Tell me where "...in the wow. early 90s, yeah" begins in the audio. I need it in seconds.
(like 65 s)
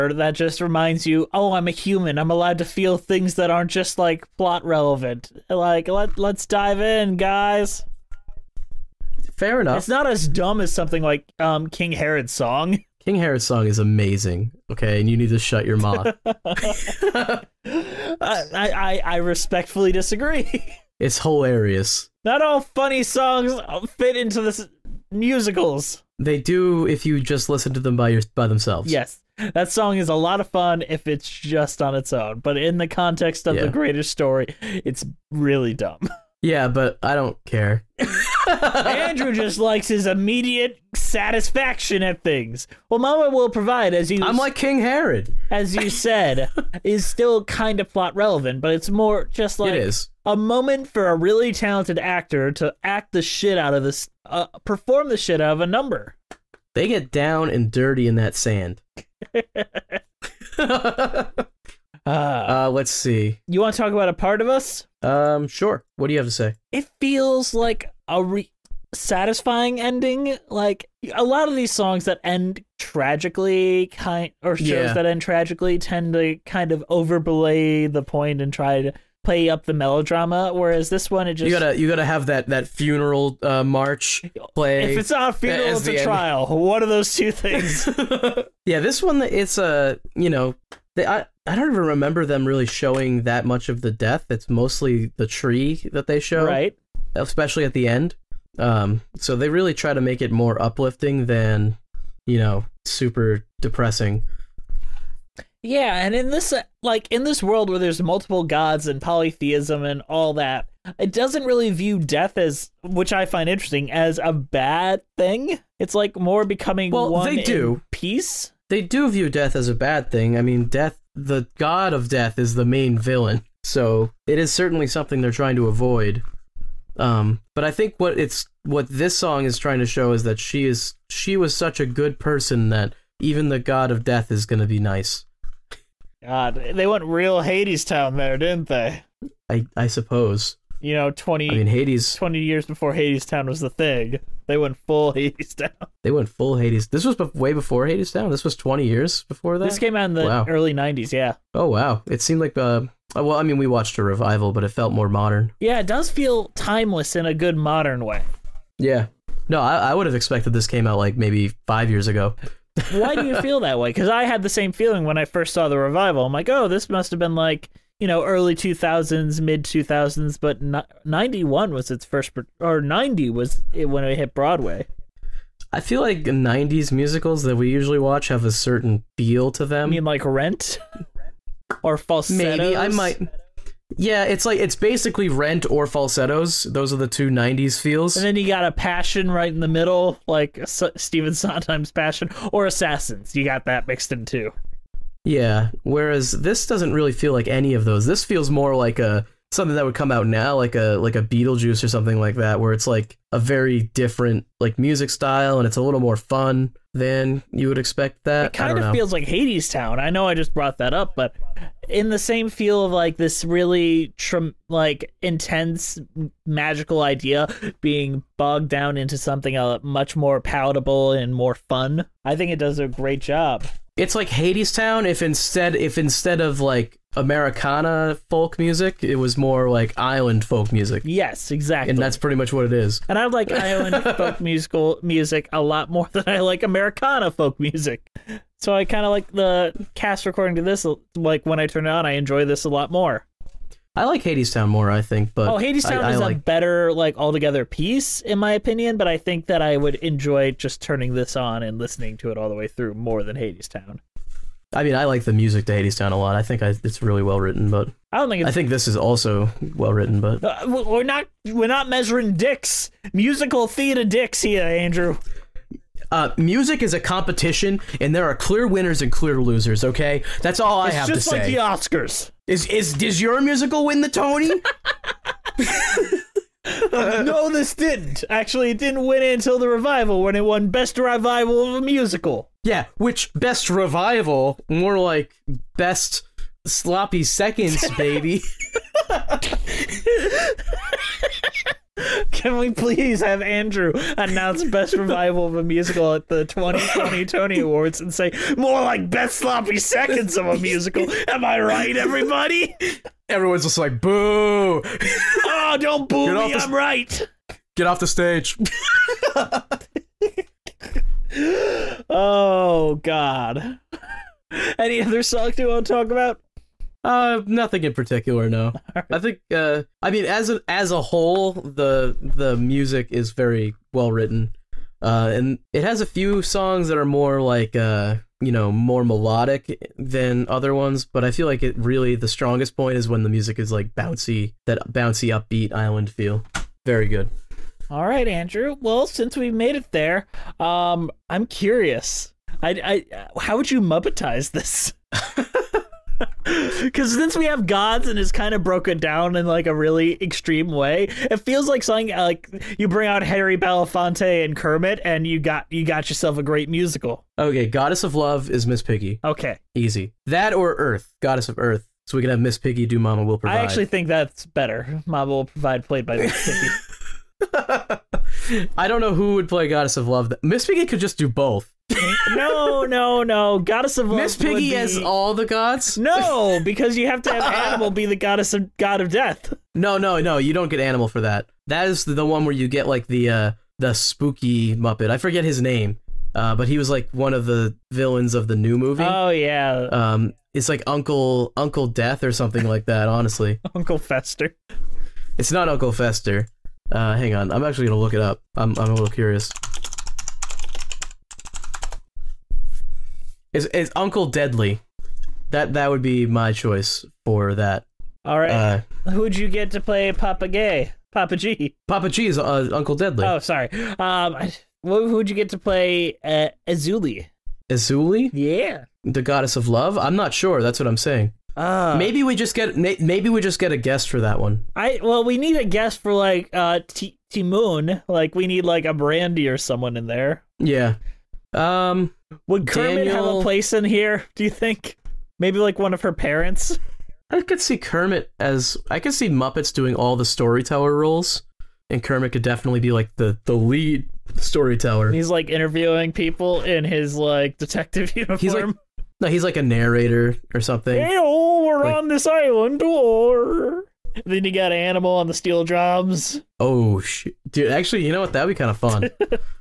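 150 s.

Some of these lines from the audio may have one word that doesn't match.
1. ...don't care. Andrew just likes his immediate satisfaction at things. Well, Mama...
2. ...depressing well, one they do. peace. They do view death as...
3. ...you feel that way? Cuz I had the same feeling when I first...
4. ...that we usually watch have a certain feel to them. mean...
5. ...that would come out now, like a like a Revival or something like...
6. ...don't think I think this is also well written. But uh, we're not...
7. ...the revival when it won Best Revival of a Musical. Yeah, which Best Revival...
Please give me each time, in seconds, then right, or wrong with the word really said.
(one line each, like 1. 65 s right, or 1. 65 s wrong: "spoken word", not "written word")
1. 37 s right
2. 116 s wrong: "becoming", not "depressing"
3. 163 s right
4. 177 s right
5. 199 s wrong: "Beetlejuice", not "Revival"
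6. 258 s right
7. 279 s right.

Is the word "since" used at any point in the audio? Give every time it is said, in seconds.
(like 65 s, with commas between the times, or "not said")
339 s, 347 s.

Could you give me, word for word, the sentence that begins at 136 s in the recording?
God, they went real Hadestown there, didn't they?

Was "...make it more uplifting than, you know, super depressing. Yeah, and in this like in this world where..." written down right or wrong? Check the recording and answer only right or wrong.
right.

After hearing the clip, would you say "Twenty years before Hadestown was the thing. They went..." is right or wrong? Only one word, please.
right.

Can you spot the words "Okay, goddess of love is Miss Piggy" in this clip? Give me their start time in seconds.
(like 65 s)
357 s.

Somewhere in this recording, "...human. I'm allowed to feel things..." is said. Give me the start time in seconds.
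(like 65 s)
1 s.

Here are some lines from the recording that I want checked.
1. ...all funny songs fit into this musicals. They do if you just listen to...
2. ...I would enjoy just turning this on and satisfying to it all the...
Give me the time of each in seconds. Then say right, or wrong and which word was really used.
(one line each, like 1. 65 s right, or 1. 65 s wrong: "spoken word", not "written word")
1. 22 s right
2. 249 s wrong: "listening", not "satisfying".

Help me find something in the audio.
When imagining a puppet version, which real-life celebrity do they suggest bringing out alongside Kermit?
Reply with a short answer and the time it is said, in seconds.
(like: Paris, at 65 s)
Harry Belafonte, at 353 s.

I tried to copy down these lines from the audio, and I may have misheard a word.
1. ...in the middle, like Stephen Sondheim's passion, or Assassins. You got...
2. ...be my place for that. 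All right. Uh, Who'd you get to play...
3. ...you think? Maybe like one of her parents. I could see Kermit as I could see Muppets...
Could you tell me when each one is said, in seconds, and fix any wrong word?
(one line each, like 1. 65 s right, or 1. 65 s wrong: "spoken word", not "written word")
1. 189 s right
2. 406 s wrong: "choice", not "place"
3. 434 s right.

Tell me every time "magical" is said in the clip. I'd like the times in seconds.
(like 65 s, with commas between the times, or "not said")
216 s.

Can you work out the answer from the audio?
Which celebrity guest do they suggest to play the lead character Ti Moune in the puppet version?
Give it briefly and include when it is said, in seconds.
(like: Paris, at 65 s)
Brandy, at 428 s.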